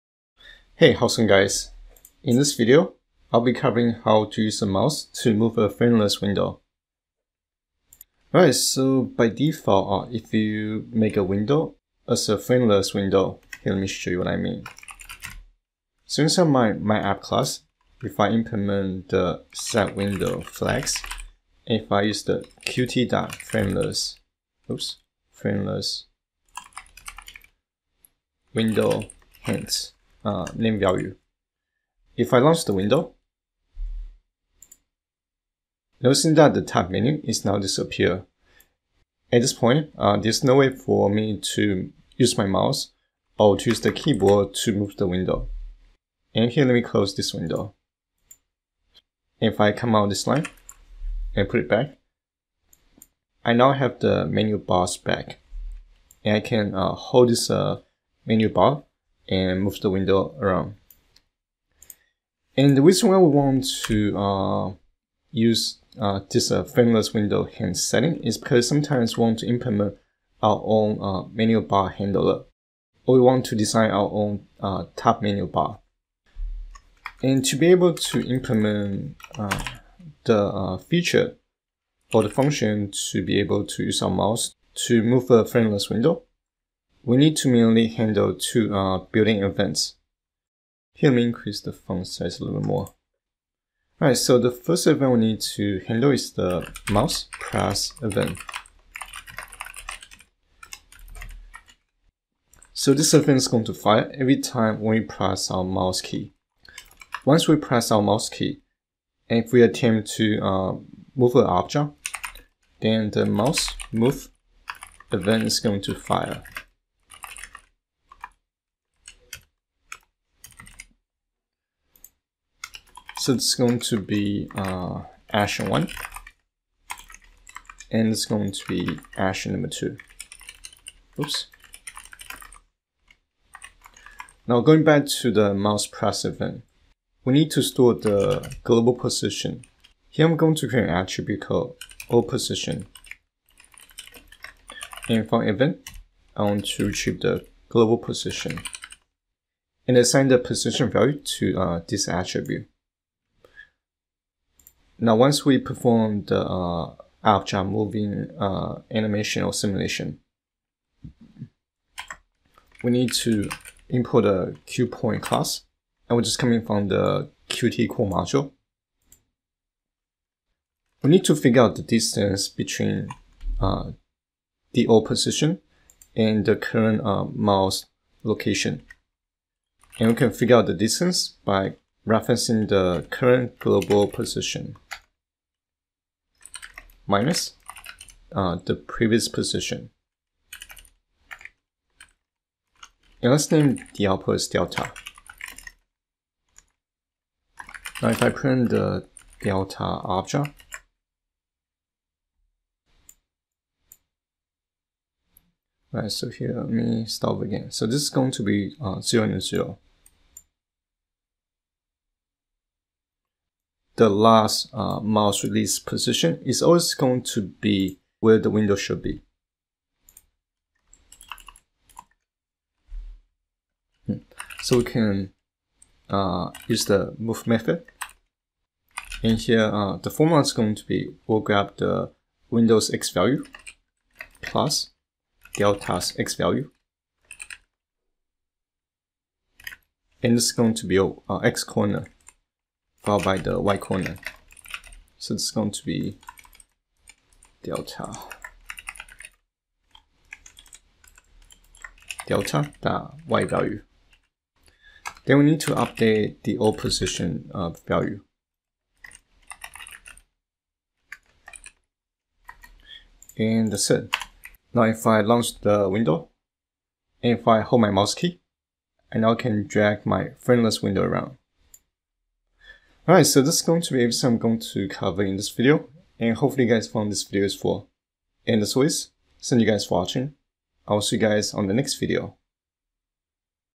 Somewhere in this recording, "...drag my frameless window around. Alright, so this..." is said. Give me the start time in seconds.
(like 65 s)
269 s.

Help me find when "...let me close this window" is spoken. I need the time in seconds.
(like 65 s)
46 s.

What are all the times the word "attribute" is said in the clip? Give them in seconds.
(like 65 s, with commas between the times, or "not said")
140 s, 152 s.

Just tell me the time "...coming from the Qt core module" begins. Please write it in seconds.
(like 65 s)
166 s.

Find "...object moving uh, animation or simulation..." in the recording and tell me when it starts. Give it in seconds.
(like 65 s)
157 s.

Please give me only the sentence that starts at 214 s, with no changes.
the last uh, mouse release position is always going to be where the window should be.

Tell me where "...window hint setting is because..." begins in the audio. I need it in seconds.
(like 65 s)
67 s.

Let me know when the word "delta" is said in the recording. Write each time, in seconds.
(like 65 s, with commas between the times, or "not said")
194 s, 199 s, 235 s, 247 s, 252 s.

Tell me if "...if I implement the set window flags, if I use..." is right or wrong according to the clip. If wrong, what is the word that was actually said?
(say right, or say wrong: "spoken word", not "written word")
right.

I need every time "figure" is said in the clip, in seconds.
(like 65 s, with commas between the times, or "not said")
171 s, 180 s.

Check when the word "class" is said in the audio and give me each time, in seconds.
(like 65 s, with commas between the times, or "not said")
17 s, 165 s.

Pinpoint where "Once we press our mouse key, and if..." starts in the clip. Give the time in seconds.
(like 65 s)
107 s.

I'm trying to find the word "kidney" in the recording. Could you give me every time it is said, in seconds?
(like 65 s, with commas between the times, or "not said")
not said.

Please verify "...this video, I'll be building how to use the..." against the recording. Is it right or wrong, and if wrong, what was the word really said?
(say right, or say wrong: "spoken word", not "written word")
wrong: "covering", not "building".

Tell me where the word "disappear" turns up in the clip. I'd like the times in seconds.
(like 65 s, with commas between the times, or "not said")
37 s.